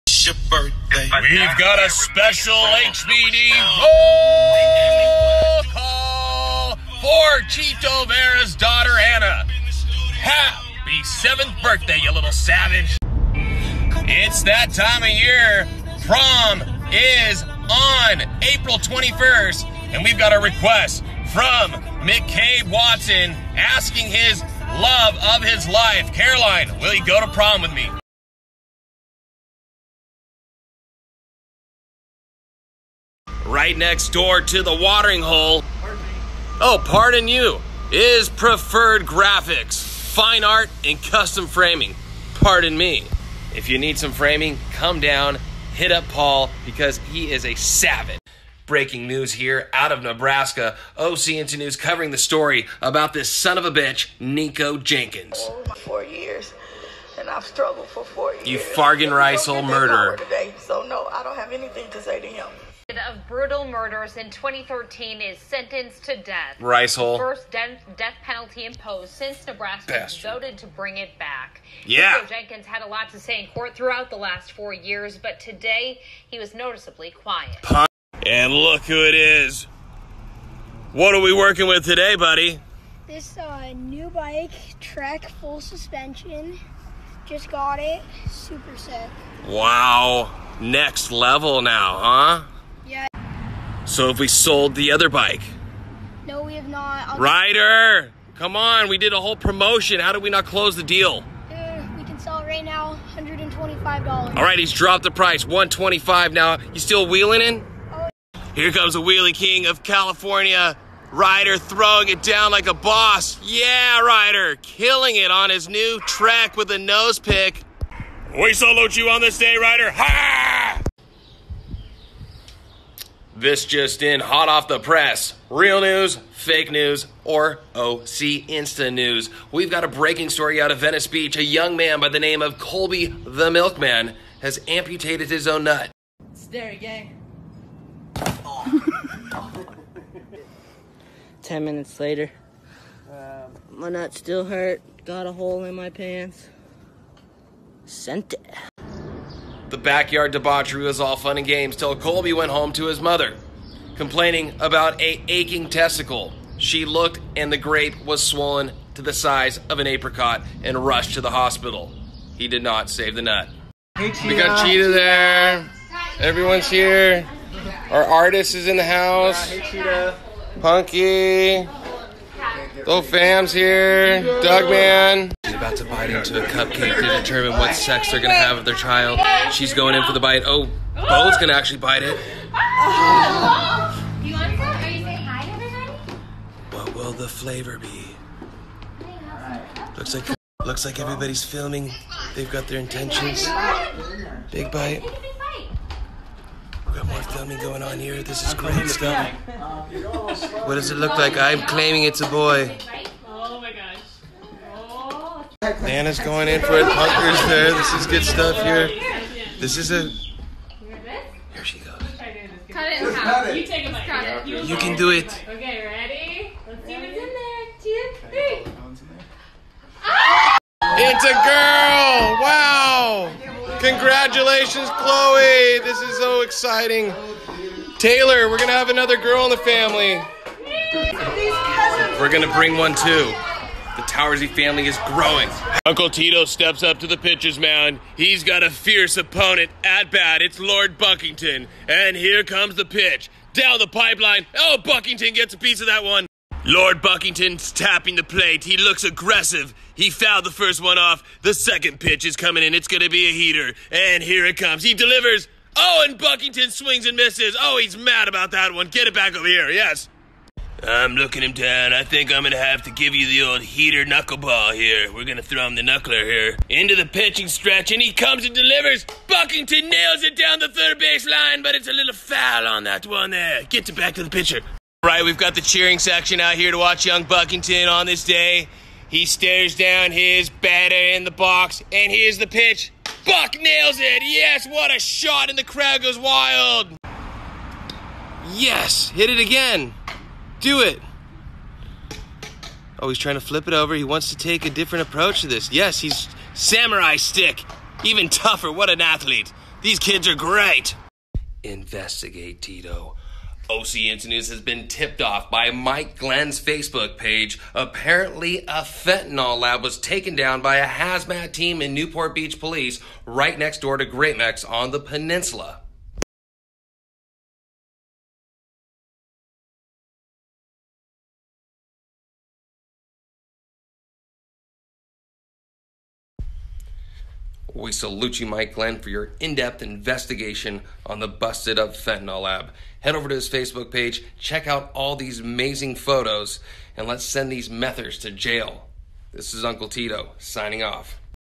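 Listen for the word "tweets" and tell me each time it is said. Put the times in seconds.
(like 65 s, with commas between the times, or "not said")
not said.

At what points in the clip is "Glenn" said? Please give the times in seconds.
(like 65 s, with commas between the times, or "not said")
306 s, 328 s.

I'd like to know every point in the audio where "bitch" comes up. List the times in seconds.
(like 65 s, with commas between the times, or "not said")
53 s.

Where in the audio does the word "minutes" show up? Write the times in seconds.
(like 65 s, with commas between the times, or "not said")
141 s.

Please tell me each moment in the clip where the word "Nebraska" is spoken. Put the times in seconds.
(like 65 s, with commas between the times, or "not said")
50 s, 69 s.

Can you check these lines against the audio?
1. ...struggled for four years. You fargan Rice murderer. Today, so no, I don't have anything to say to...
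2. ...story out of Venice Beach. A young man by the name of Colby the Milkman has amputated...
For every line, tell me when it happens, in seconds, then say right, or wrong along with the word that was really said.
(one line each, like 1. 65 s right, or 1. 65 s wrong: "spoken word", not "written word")
1. 57 s right
2. 130 s right.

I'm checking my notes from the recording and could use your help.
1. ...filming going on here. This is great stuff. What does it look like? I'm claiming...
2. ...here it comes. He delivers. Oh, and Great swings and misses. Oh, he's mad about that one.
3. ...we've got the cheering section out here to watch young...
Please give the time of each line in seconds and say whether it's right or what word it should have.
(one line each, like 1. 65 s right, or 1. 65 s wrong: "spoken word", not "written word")
1. 197 s right
2. 254 s wrong: "Buckington", not "Great"
3. 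275 s right.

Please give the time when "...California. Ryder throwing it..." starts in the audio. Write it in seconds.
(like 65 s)
109 s.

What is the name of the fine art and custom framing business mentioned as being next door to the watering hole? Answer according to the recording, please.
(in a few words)
Preferred Graphics.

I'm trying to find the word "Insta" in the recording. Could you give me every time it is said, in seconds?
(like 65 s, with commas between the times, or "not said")
51 s, 128 s.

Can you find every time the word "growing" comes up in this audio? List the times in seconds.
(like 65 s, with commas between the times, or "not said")
235 s.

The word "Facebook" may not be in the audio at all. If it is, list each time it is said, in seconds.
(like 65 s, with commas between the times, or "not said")
306 s, 333 s.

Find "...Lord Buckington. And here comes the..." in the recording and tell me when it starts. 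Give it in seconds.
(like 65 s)
240 s.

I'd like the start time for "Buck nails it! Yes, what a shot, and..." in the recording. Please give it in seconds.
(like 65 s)
283 s.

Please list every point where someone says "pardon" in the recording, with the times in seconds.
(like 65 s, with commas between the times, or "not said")
36 s, 42 s.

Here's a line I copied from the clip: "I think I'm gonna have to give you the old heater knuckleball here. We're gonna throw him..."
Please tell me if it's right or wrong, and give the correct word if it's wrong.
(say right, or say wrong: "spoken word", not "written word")
right.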